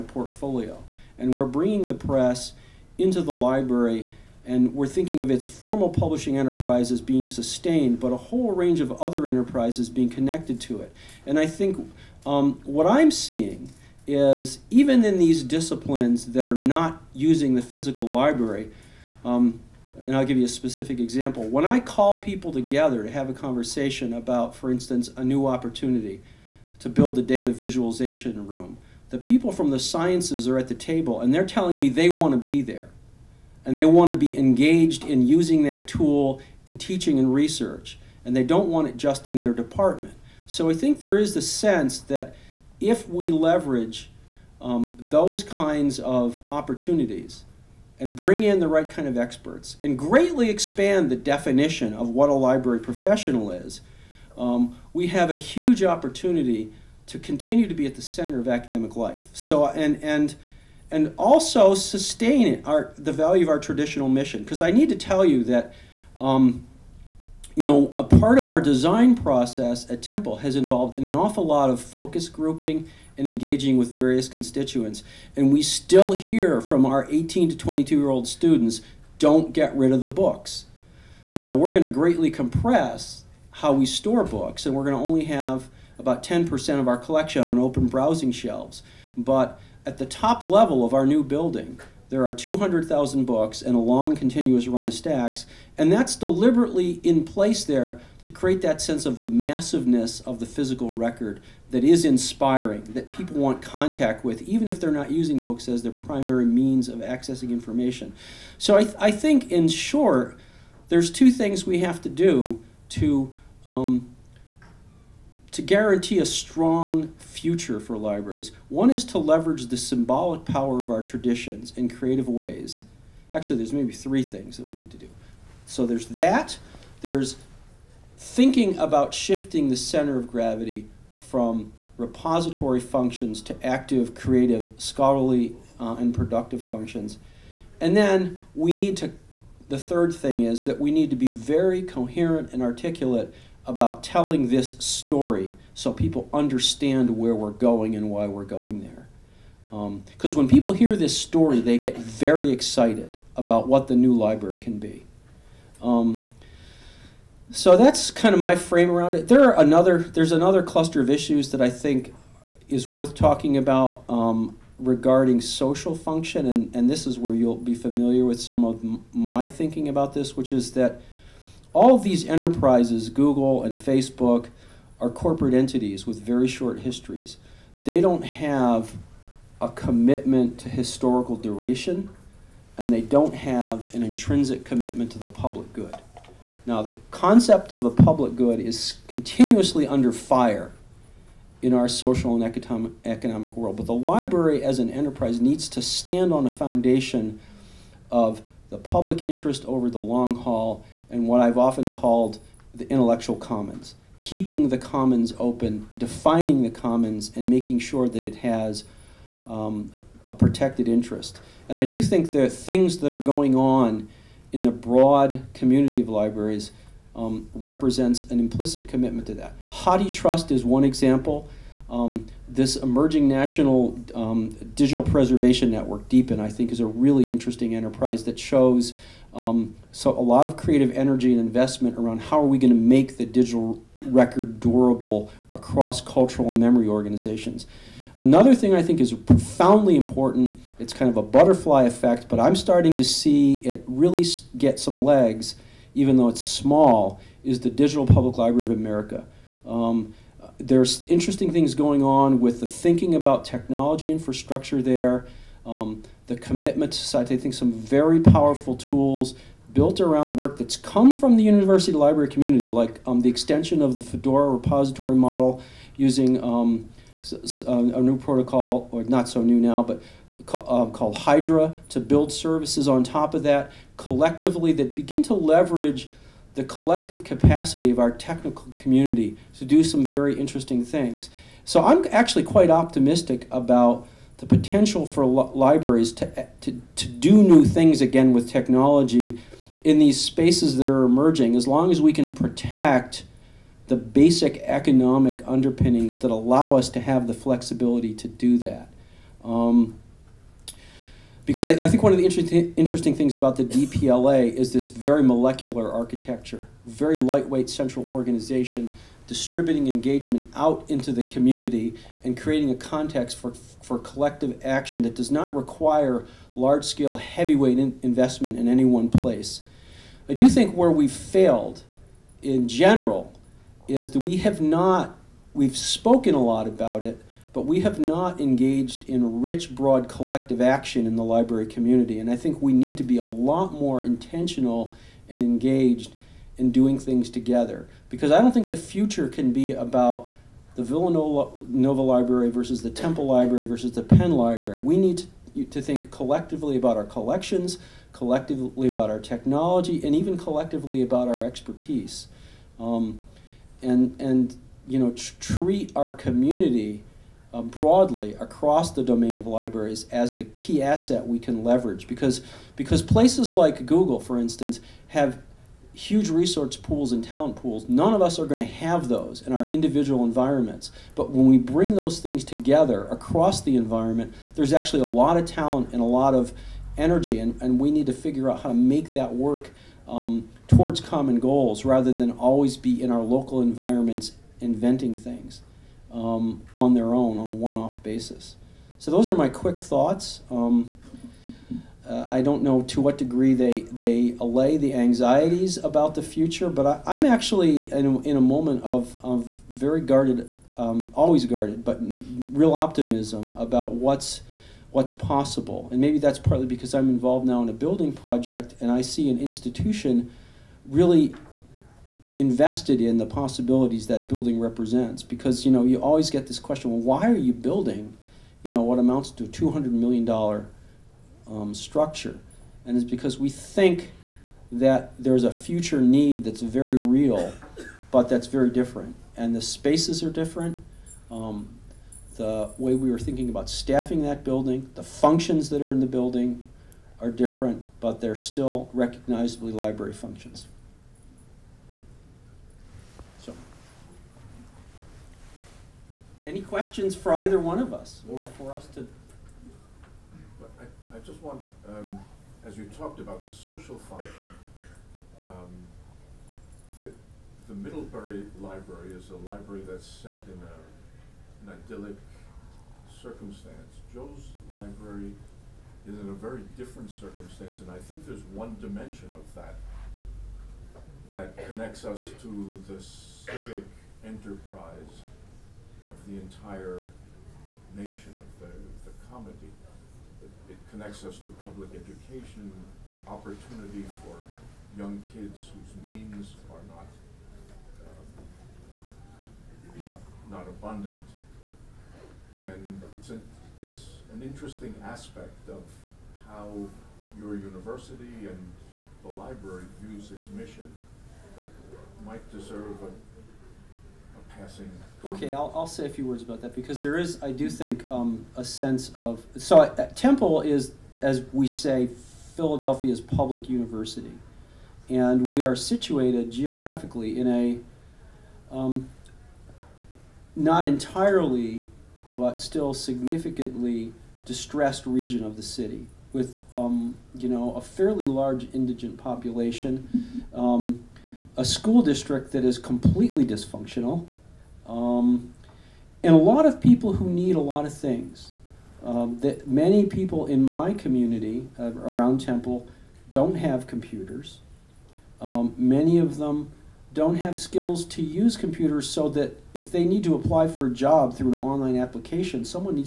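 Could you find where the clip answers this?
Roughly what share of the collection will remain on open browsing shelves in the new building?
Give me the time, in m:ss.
1:26.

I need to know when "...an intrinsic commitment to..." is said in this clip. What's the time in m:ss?
3:03.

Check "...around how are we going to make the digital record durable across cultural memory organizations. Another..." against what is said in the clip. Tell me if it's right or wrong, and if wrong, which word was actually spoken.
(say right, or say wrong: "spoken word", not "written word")
right.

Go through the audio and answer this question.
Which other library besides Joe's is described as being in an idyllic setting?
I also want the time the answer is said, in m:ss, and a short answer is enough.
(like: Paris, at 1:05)
Middlebury, at 7:37.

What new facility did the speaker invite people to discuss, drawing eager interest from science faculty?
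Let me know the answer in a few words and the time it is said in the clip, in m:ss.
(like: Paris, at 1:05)
data visualization room, at 0:27.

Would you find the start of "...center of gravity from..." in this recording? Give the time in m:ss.
2:09.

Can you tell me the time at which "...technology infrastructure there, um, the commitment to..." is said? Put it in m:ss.
4:13.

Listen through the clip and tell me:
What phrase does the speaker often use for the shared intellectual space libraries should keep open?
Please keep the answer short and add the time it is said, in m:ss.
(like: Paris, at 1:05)
intellectual commons, at 3:22.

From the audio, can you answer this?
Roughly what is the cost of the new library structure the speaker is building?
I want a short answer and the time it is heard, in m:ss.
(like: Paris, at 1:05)
200 million dollars, at 6:59.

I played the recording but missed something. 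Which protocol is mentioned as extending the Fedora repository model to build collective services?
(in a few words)
Hydra.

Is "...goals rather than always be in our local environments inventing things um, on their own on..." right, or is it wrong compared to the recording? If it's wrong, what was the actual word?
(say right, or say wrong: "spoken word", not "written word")
right.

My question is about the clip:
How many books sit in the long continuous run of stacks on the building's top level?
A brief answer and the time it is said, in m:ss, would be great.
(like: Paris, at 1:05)
200,000, at 1:32.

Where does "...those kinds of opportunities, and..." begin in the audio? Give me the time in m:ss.
0:44.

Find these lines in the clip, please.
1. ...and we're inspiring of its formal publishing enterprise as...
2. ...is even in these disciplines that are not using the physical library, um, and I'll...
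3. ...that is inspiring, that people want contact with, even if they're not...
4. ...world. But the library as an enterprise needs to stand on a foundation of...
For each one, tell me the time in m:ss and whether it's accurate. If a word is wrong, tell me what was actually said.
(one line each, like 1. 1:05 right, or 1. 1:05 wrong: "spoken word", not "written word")
1. 0:04 wrong: "thinking", not "inspiring"
2. 0:14 right
3. 1:41 right
4. 3:13 right.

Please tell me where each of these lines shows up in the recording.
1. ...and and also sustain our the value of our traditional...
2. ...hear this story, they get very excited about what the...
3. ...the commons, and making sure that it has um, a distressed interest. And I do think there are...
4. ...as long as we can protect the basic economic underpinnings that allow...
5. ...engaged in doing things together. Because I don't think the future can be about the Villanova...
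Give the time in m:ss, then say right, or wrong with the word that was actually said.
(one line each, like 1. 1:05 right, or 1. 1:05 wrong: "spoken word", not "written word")
1. 1:00 right
2. 2:30 right
3. 3:26 wrong: "protected", not "distressed"
4. 4:51 right
5. 5:35 right.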